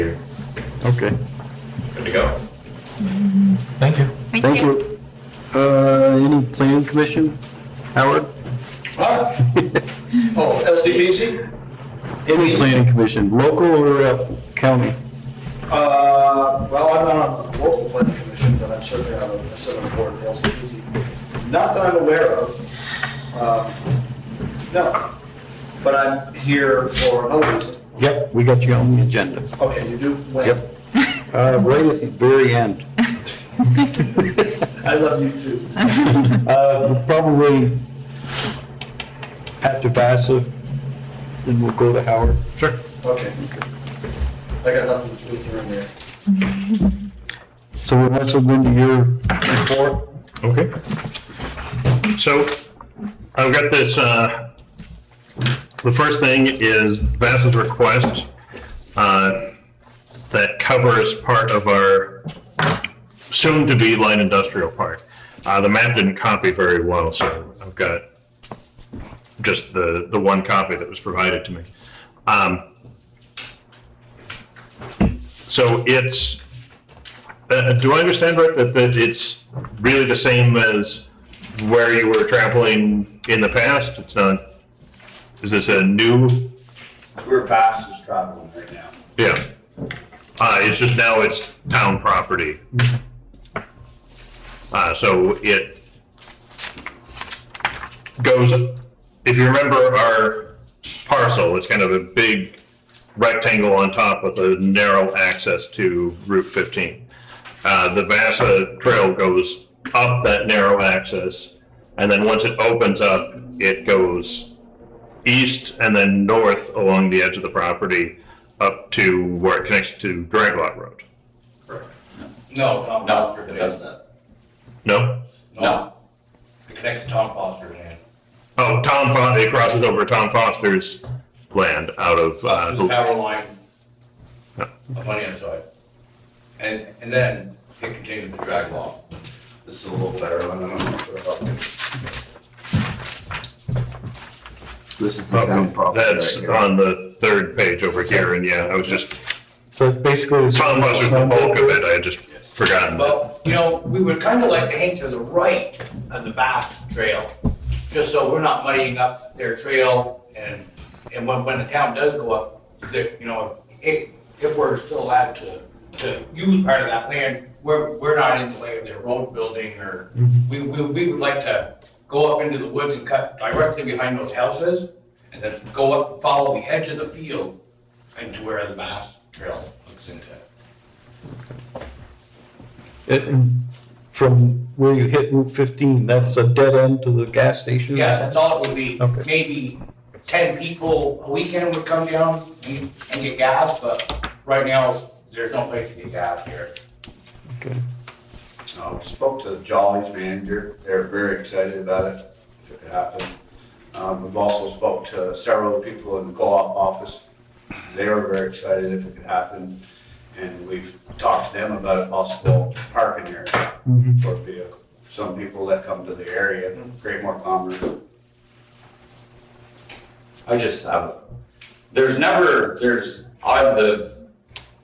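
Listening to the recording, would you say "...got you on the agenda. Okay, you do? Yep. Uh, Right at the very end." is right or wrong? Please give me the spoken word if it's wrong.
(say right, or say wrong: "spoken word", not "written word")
right.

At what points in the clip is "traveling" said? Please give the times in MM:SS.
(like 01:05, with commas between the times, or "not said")
01:22, 01:28.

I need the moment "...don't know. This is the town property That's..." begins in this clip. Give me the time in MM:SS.
02:20.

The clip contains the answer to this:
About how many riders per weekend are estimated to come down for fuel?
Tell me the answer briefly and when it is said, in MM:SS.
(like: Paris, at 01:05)
10, at 03:10.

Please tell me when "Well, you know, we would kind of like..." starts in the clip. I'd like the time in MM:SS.
02:33.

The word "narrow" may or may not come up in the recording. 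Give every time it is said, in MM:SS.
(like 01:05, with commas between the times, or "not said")
01:44, 01:50.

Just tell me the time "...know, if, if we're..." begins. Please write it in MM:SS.
02:43.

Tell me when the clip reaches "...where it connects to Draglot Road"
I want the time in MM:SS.
01:59.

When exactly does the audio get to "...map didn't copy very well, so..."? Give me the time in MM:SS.
01:05.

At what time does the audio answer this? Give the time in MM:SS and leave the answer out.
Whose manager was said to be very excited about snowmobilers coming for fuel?
03:19.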